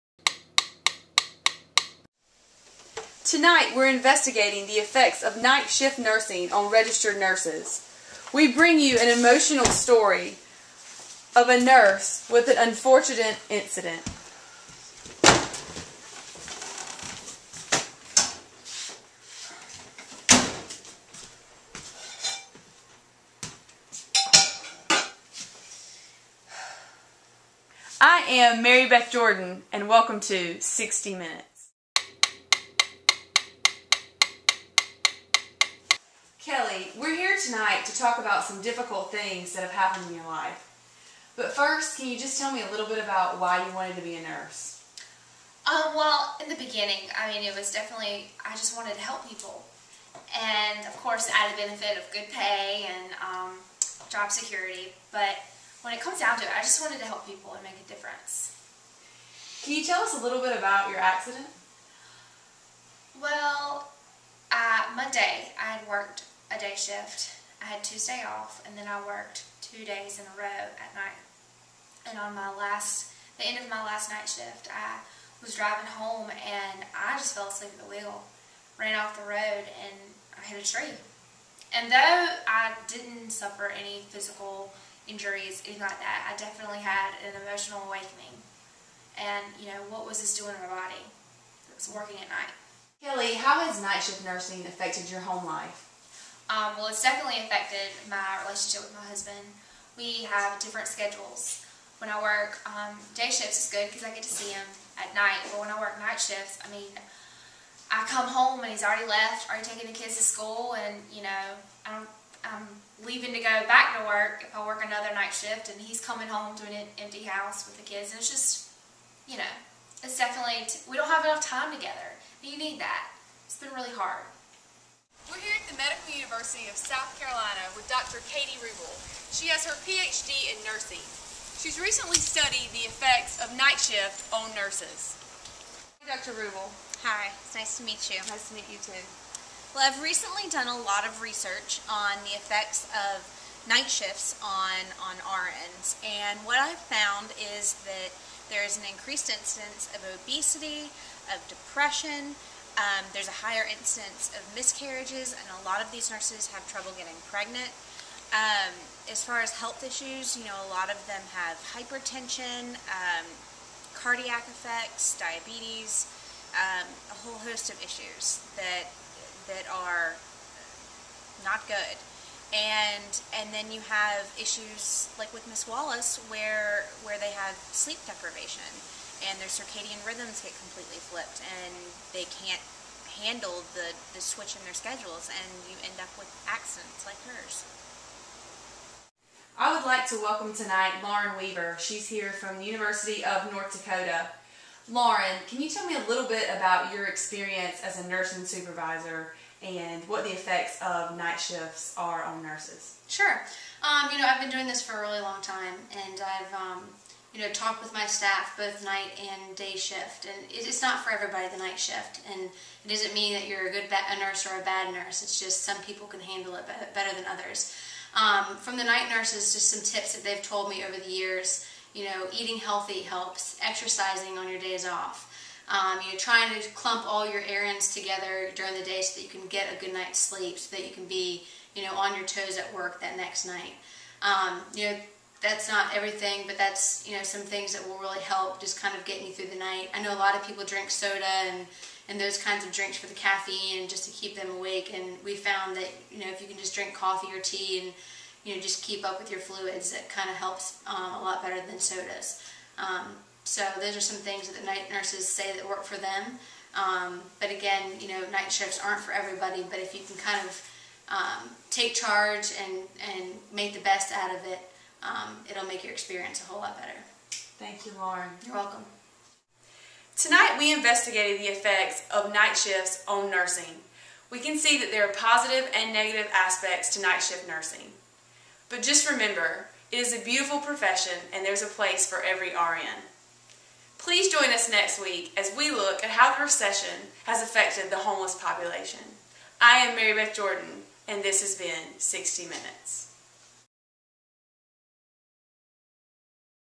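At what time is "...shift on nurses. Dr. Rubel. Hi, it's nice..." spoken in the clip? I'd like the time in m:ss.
2:13.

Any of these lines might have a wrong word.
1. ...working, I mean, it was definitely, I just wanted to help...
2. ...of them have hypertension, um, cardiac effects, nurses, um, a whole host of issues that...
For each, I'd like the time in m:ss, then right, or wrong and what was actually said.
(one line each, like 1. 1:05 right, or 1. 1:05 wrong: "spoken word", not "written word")
1. 0:46 wrong: "beginning", not "working"
2. 2:40 wrong: "diabetes", not "nurses".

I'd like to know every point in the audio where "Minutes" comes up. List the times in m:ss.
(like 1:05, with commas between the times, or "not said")
0:31, 4:52.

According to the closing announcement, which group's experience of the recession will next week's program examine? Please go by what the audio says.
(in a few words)
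The homeless population.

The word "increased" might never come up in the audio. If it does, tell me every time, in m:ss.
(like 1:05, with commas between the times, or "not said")
2:28.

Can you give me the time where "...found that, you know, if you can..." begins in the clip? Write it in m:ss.
4:05.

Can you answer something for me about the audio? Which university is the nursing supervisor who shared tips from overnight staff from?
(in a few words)
University of North Dakota.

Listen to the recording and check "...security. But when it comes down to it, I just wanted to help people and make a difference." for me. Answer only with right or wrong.
right.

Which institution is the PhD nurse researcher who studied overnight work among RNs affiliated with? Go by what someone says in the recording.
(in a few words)
Medical University of South Carolina.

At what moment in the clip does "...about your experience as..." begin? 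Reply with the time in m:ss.
3:16.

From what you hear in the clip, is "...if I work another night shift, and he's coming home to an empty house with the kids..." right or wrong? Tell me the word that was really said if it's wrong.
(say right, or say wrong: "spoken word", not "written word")
right.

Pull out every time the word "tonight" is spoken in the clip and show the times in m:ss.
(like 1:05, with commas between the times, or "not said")
0:03, 0:37, 3:10, 4:30.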